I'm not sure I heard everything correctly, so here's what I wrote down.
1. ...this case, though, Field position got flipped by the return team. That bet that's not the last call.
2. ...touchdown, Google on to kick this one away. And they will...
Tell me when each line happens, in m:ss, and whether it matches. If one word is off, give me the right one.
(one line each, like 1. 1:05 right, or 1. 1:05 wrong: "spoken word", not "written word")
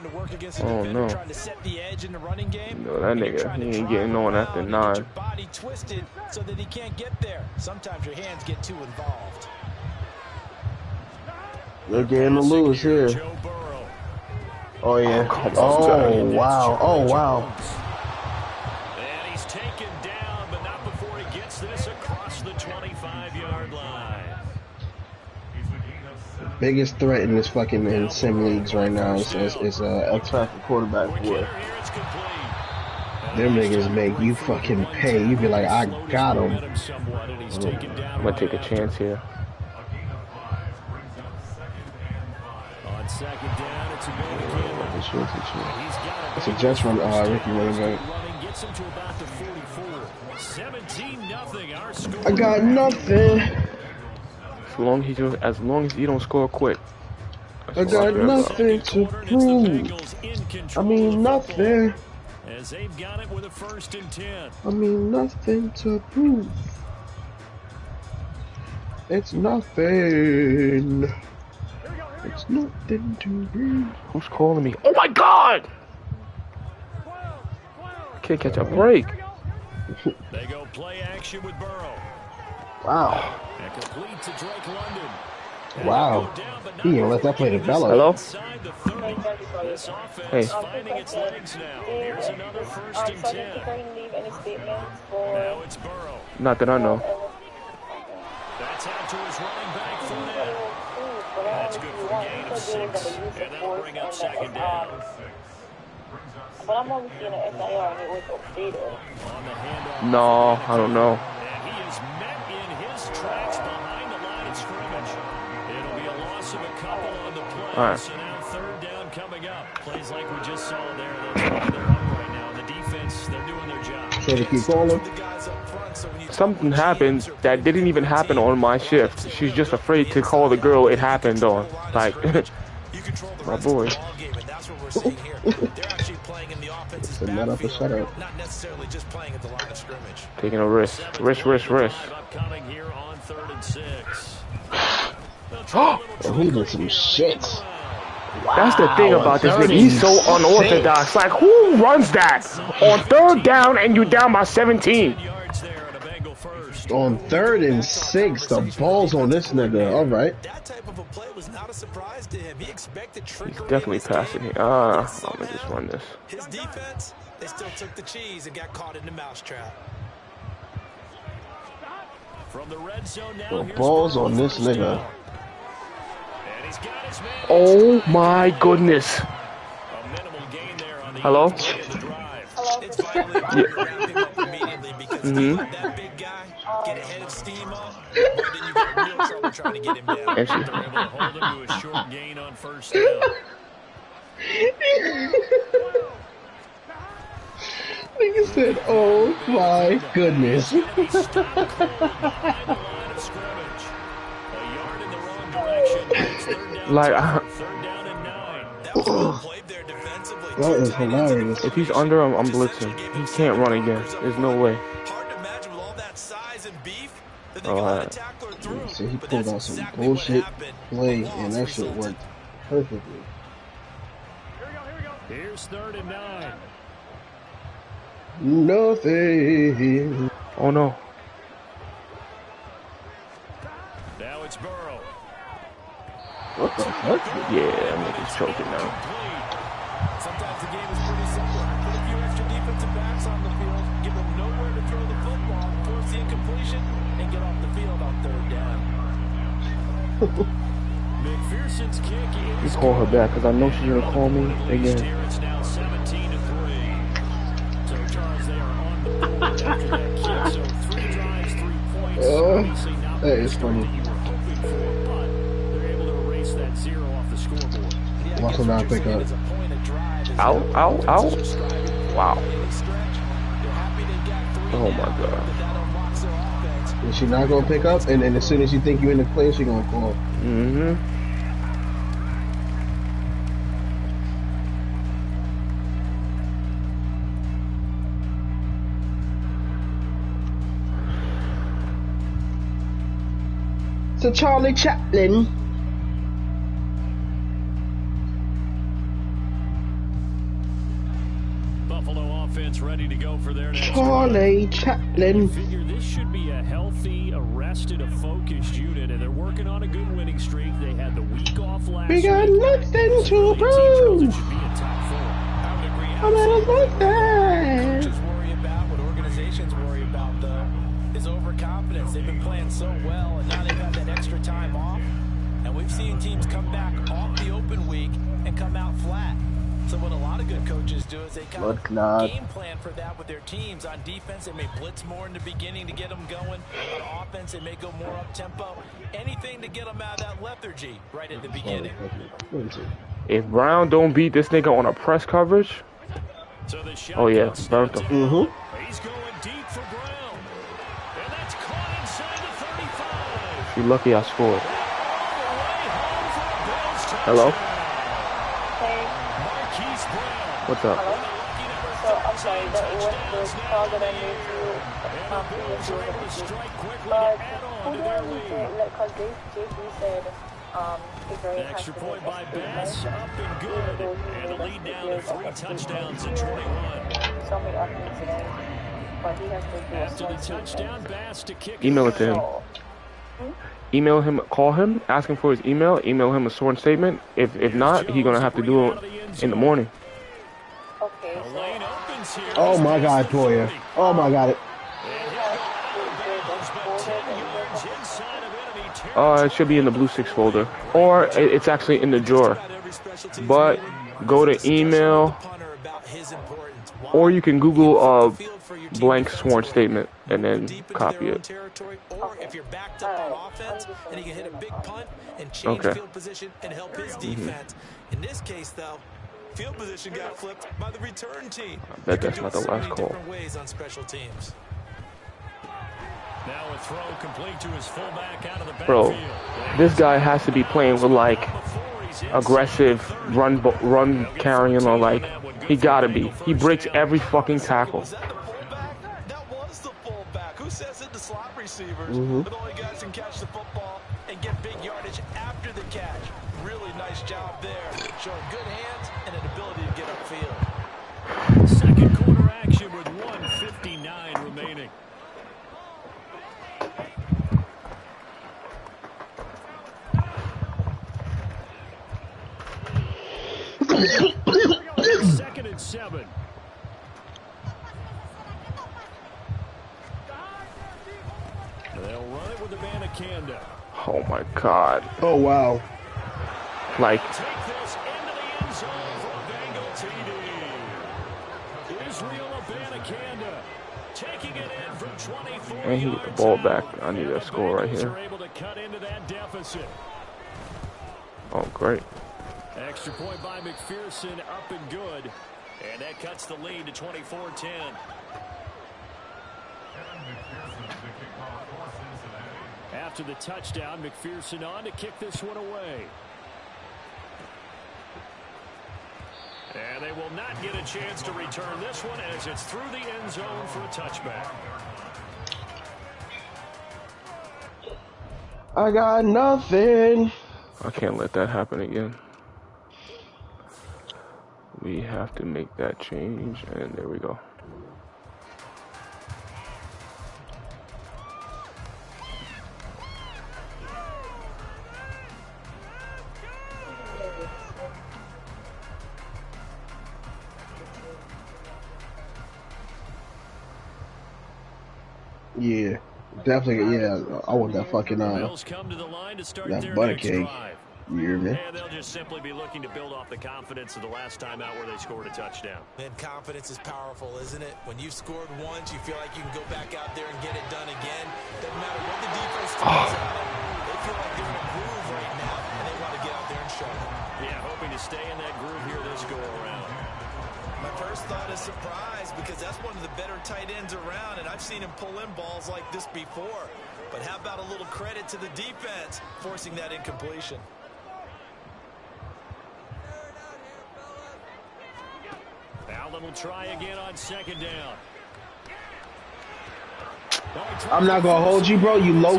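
1. 6:58 right
2. 8:23 wrong: "McPherson", not "Google".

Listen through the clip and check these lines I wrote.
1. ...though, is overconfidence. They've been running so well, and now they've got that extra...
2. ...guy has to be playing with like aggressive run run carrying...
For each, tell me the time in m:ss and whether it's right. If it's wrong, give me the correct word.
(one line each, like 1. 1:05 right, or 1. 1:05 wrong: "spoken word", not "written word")
1. 5:20 wrong: "playing", not "running"
2. 7:09 right.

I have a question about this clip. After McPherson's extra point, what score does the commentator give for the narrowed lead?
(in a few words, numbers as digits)
24-10.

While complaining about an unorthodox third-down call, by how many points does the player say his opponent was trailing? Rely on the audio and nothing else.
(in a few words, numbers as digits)
17.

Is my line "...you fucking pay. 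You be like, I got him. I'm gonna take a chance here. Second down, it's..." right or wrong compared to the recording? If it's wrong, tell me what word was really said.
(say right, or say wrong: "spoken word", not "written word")
right.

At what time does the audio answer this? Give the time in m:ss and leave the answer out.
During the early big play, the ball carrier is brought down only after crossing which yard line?
0:22.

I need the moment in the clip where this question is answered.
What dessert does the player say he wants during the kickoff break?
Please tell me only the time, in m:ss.
9:09.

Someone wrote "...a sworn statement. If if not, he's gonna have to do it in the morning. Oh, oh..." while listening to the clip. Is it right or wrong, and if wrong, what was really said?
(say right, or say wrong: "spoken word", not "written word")
right.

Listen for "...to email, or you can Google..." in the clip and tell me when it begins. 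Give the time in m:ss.
6:44.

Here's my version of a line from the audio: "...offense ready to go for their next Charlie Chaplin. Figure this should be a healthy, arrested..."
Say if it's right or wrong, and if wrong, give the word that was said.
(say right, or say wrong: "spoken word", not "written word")
right.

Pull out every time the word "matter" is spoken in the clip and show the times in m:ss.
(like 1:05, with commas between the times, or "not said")
9:21.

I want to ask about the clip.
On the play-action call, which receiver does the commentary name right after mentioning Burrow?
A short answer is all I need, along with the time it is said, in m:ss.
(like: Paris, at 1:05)
Drake London, at 1:23.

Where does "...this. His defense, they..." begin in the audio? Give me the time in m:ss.
2:45.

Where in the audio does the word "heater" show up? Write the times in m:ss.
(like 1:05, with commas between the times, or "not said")
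not said.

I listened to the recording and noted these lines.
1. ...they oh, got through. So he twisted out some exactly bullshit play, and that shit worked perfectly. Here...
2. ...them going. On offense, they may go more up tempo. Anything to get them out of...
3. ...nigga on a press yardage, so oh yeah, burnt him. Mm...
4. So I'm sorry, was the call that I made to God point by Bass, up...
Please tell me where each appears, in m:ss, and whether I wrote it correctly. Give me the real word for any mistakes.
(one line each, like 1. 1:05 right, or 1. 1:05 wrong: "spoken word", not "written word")
1. 3:37 wrong: "pulled", not "twisted"
2. 5:36 right
3. 5:44 wrong: "coverage", not "yardage"
4. 6:02 wrong: "Extra", not "God".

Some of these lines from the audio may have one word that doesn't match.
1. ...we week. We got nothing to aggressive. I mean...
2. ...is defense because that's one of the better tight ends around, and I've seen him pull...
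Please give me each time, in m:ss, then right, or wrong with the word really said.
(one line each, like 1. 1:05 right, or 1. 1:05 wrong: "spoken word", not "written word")
1. 5:12 wrong: "prove", not "aggressive"
2. 9:31 wrong: "surprise", not "defense".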